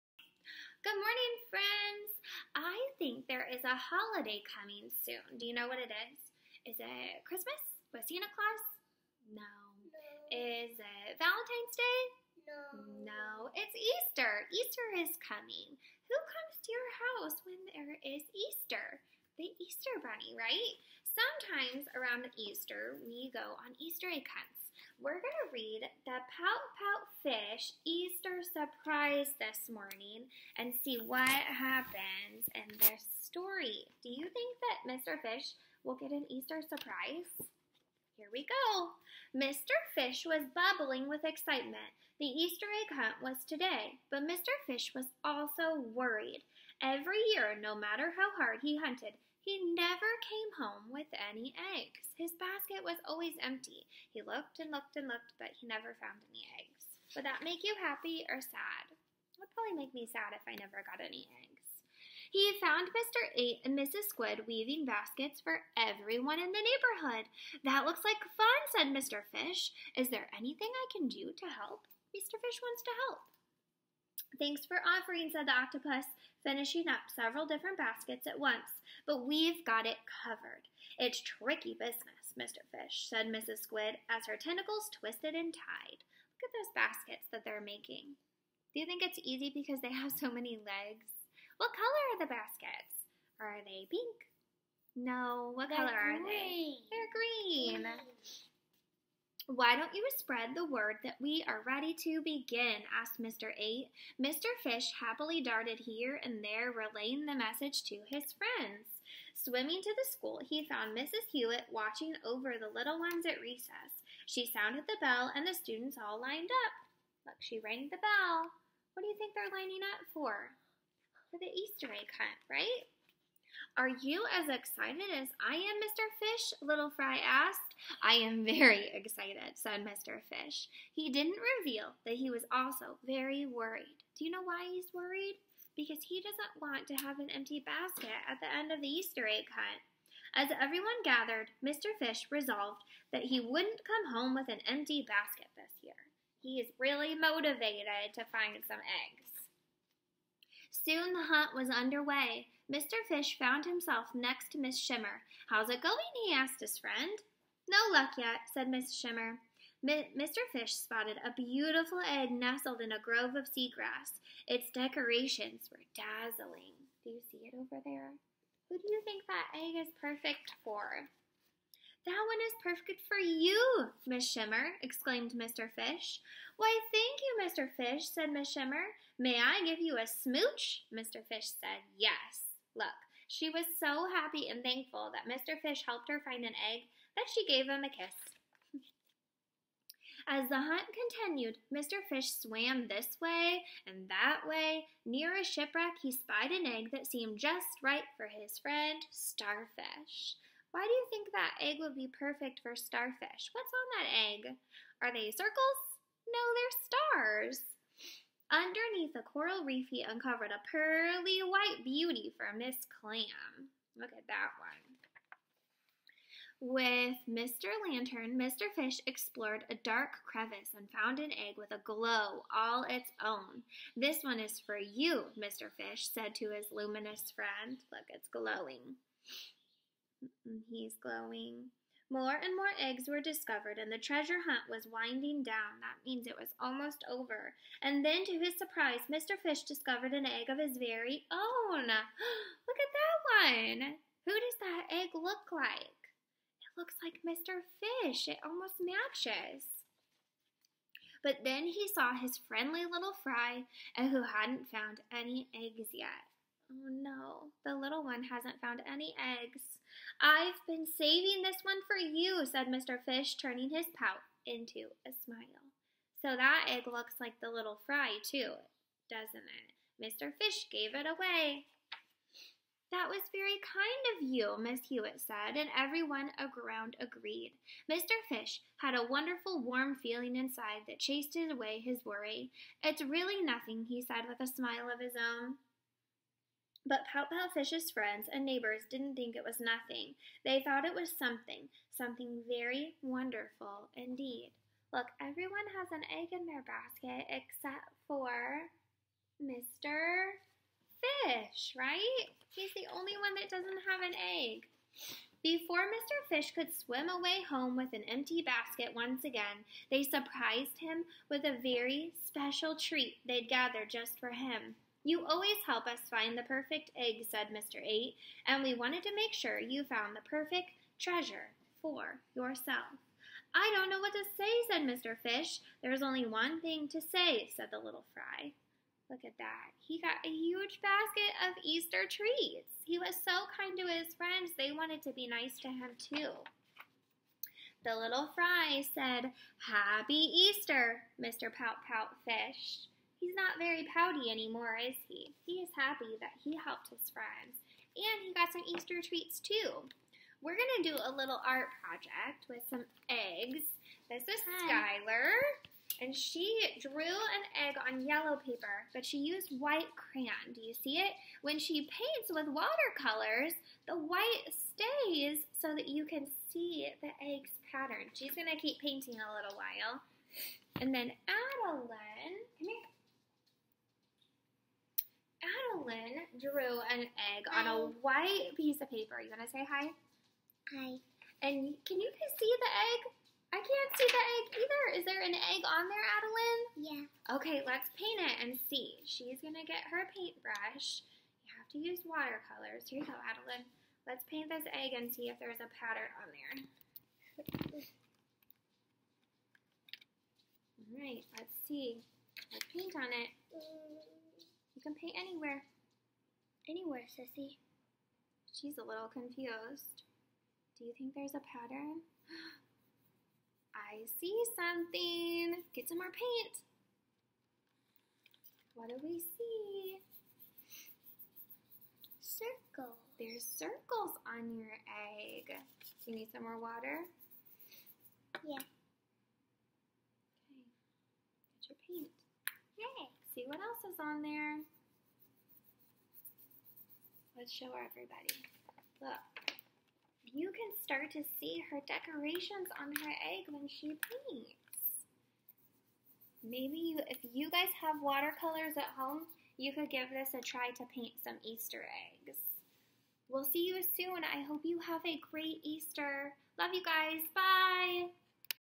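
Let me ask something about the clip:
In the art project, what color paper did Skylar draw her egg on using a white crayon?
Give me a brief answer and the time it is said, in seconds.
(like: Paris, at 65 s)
Yellow, at 358 s.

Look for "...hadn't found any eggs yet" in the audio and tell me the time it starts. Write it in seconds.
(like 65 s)
254 s.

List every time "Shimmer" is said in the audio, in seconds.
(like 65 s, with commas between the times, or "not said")
154 s, 158 s, 174 s, 178 s.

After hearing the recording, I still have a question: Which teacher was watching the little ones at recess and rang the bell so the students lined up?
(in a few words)
Mrs. Hewitt.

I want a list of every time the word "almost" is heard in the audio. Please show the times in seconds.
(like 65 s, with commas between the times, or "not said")
236 s, 248 s.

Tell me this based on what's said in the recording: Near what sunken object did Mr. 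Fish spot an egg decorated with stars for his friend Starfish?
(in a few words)
A shipwreck.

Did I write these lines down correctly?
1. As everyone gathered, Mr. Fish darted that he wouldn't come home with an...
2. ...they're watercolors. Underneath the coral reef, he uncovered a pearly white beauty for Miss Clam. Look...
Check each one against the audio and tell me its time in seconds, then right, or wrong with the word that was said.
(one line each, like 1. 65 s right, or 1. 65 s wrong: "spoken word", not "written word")
1. 140 s wrong: "resolved", not "darted"
2. 206 s wrong: "stars", not "watercolors".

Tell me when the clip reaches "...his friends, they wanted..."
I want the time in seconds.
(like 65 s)
333 s.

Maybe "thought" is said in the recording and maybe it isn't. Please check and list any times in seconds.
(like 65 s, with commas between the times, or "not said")
290 s.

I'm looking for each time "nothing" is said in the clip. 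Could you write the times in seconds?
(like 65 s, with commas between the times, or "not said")
283 s, 289 s.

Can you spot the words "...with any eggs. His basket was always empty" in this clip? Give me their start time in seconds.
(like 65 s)
50 s.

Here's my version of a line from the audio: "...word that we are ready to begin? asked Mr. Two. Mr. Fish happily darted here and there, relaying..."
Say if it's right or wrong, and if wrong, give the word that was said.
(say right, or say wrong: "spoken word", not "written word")
wrong: "Eight", not "Two".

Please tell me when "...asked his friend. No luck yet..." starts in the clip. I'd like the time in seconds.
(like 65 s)
156 s.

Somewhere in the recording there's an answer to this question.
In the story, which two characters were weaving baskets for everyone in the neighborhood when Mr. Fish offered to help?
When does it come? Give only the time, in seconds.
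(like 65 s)
62 s.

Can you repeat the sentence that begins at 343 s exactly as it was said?
He's not very pouty anymore, is he?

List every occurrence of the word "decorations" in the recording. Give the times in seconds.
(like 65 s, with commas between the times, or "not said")
164 s, 441 s.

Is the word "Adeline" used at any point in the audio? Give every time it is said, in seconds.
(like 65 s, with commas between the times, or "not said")
371 s, 386 s, 393 s.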